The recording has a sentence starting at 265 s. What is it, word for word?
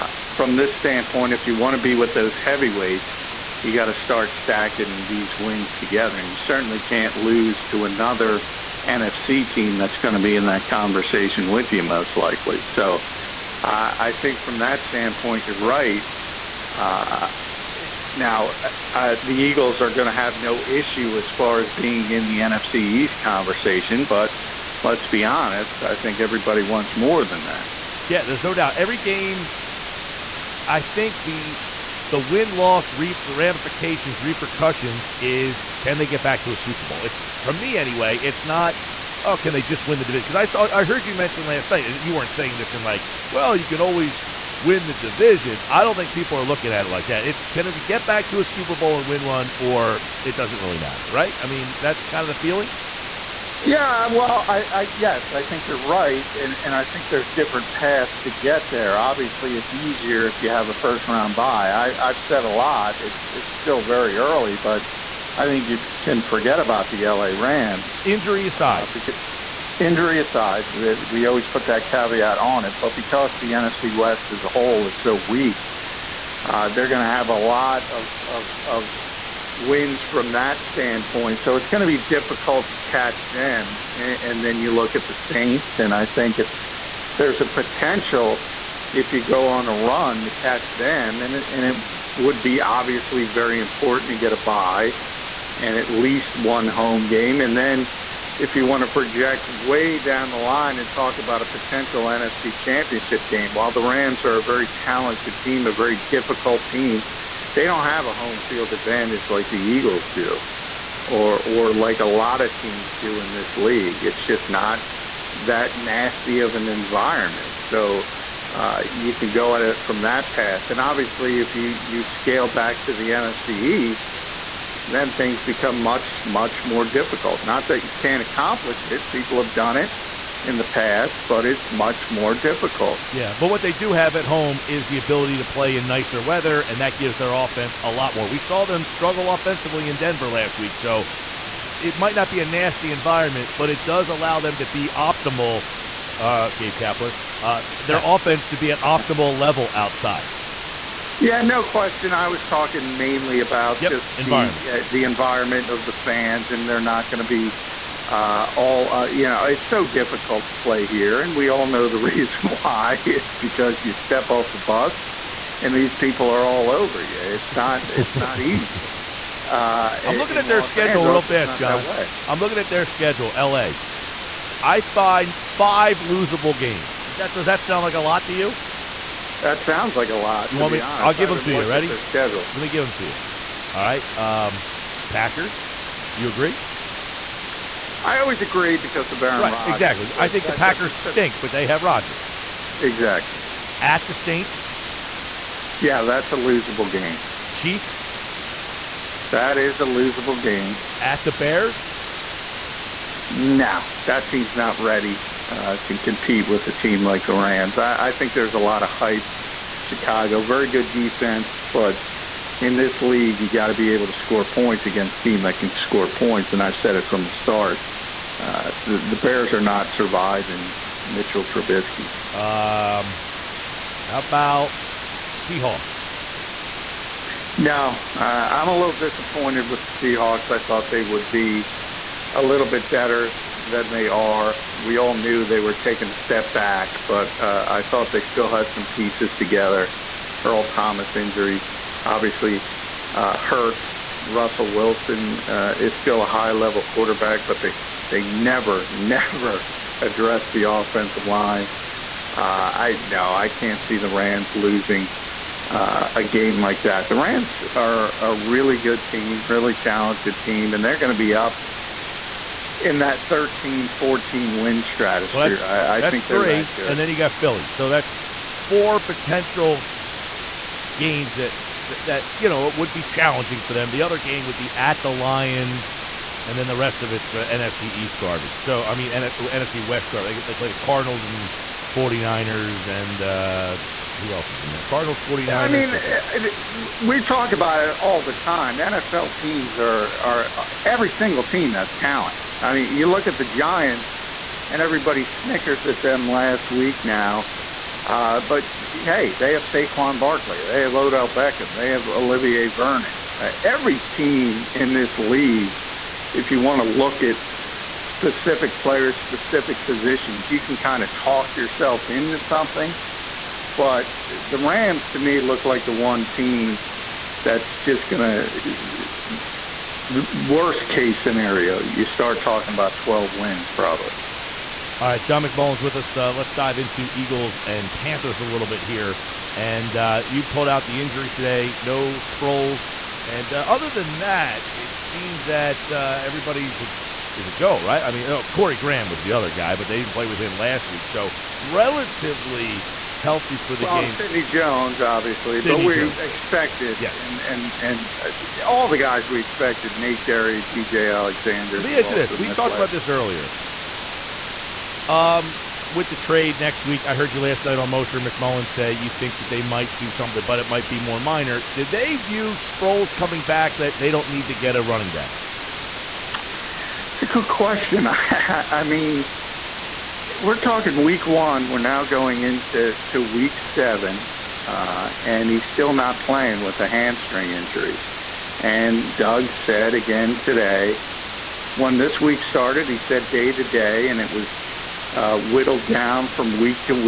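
Well, that's, I, I that's think three, that and then you got Philly.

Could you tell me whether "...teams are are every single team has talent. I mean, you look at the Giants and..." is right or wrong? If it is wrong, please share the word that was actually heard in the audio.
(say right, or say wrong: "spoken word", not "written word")
right.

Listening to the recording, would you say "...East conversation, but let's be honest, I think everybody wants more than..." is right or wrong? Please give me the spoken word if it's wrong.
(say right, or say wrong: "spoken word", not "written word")
right.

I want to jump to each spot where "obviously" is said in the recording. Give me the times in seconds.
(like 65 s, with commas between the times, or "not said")
58 s, 92 s, 120 s, 242 s, 345 s.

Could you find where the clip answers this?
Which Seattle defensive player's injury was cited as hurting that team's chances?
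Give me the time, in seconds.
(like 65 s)
240 s.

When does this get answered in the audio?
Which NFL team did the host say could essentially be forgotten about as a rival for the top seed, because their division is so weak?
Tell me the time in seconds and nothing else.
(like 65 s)
67 s.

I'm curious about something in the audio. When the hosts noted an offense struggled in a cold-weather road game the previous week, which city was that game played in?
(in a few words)
Denver.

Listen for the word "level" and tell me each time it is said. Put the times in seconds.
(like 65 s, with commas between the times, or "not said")
149 s, 246 s.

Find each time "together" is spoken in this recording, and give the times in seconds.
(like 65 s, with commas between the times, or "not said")
5 s, 239 s.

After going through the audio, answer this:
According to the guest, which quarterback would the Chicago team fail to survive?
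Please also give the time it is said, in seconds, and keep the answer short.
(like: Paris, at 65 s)
Mitchell Trubisky, at 221 s.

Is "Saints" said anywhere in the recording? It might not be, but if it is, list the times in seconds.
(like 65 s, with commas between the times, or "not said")
85 s, 194 s.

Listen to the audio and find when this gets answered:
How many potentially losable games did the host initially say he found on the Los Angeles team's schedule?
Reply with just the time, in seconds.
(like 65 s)
175 s.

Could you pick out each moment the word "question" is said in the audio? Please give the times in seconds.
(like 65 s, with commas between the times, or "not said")
151 s, 367 s.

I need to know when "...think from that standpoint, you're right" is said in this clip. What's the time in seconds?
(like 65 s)
14 s.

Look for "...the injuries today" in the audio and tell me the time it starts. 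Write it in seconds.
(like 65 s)
330 s.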